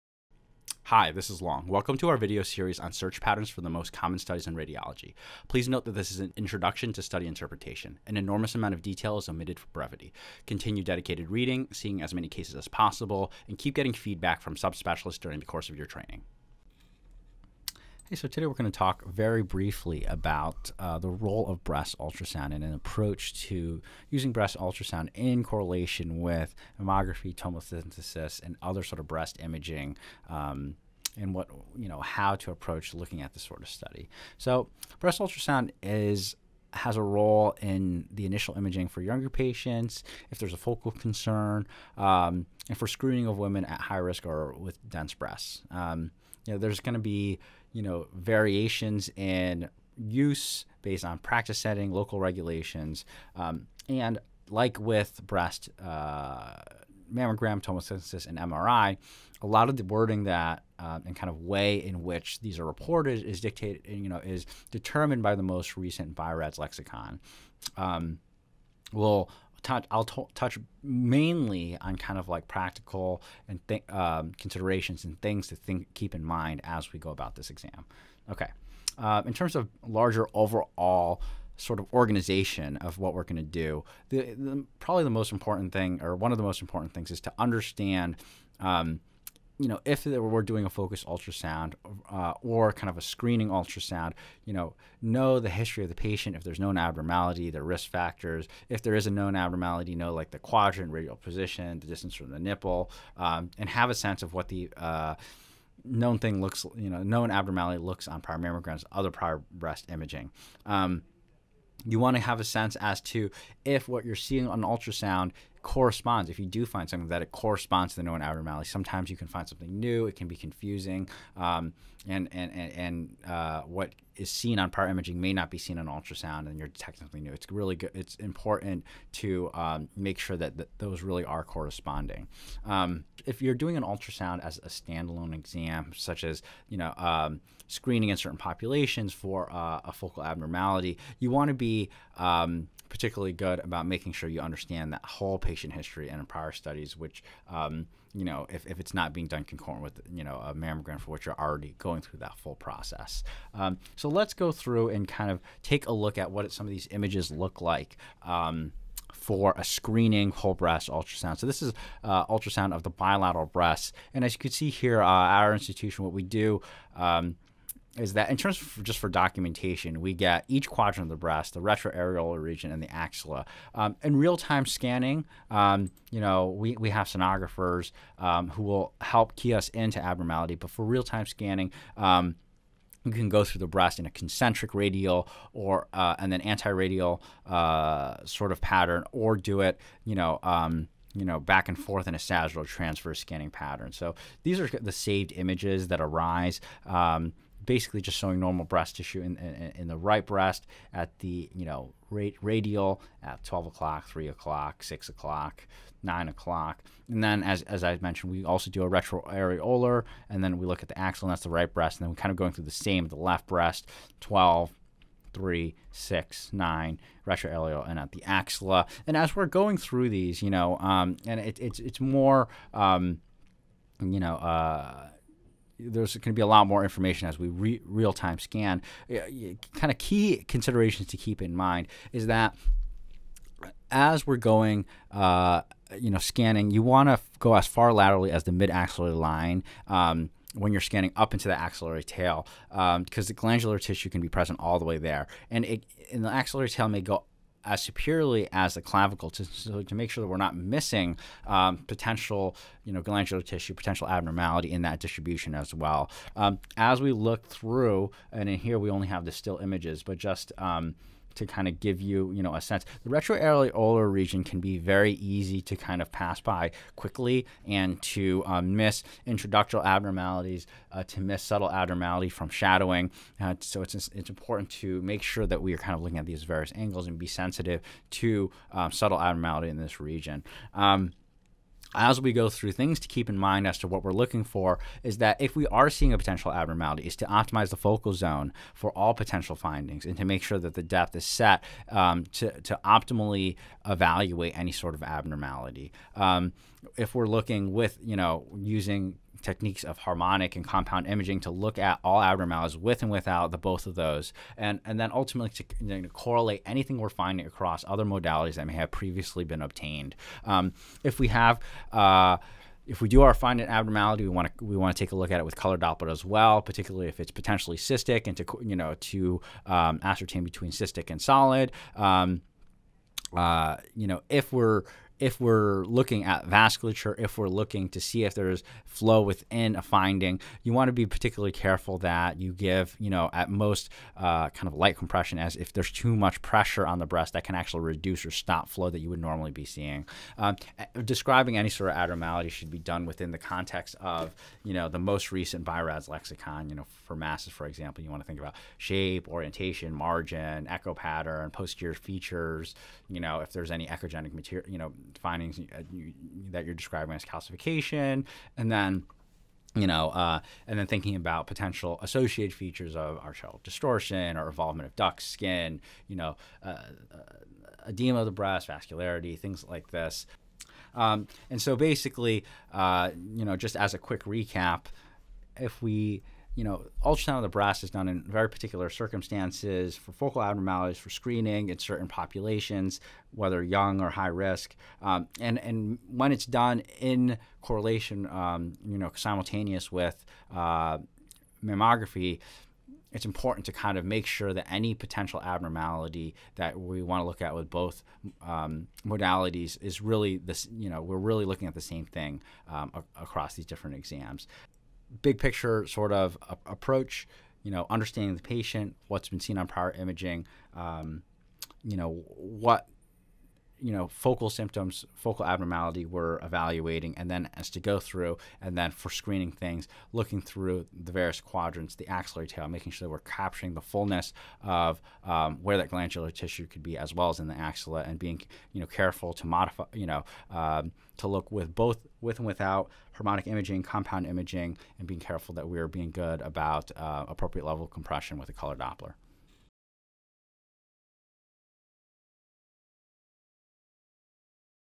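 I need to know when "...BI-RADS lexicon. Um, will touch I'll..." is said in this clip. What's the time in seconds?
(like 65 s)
66 s.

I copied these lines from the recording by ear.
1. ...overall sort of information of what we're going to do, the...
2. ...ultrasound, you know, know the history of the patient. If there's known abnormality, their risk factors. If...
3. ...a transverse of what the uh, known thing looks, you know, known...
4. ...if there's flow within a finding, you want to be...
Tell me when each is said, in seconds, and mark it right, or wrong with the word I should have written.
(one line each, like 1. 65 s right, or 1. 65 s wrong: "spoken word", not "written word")
1. 80 s wrong: "organization", not "information"
2. 93 s right
3. 103 s wrong: "sense", not "transverse"
4. 328 s right.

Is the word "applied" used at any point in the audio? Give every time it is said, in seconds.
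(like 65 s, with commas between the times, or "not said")
not said.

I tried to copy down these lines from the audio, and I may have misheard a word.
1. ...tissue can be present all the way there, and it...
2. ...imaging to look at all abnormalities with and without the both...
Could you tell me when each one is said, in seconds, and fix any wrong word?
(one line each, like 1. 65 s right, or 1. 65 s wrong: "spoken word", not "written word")
1. 243 s right
2. 301 s right.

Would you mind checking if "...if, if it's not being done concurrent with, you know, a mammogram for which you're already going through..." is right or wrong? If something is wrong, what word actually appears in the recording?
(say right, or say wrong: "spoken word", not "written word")
right.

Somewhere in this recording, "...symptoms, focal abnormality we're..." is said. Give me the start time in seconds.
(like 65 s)
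414 s.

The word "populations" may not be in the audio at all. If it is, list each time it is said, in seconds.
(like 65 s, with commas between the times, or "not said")
138 s, 382 s.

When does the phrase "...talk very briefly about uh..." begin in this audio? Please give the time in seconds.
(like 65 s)
18 s.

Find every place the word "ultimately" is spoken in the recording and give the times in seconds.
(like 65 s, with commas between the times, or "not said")
305 s.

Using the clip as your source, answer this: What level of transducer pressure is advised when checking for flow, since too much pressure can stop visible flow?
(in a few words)
Light compression.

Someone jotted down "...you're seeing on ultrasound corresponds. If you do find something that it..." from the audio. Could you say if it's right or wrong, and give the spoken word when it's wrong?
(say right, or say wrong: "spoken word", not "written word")
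right.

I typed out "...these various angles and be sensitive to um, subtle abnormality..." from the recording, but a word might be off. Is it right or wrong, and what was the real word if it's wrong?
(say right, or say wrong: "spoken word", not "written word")
right.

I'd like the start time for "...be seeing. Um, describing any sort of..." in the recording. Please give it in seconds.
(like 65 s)
339 s.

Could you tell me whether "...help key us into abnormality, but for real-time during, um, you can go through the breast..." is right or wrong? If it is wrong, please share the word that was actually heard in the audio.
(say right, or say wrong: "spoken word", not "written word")
wrong: "scanning", not "during".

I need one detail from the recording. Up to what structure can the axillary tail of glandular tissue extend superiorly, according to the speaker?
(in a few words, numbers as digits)
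The clavicle.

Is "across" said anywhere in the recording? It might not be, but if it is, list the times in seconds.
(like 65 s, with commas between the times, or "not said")
307 s, 403 s.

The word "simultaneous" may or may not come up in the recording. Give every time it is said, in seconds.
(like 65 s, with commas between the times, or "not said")
389 s.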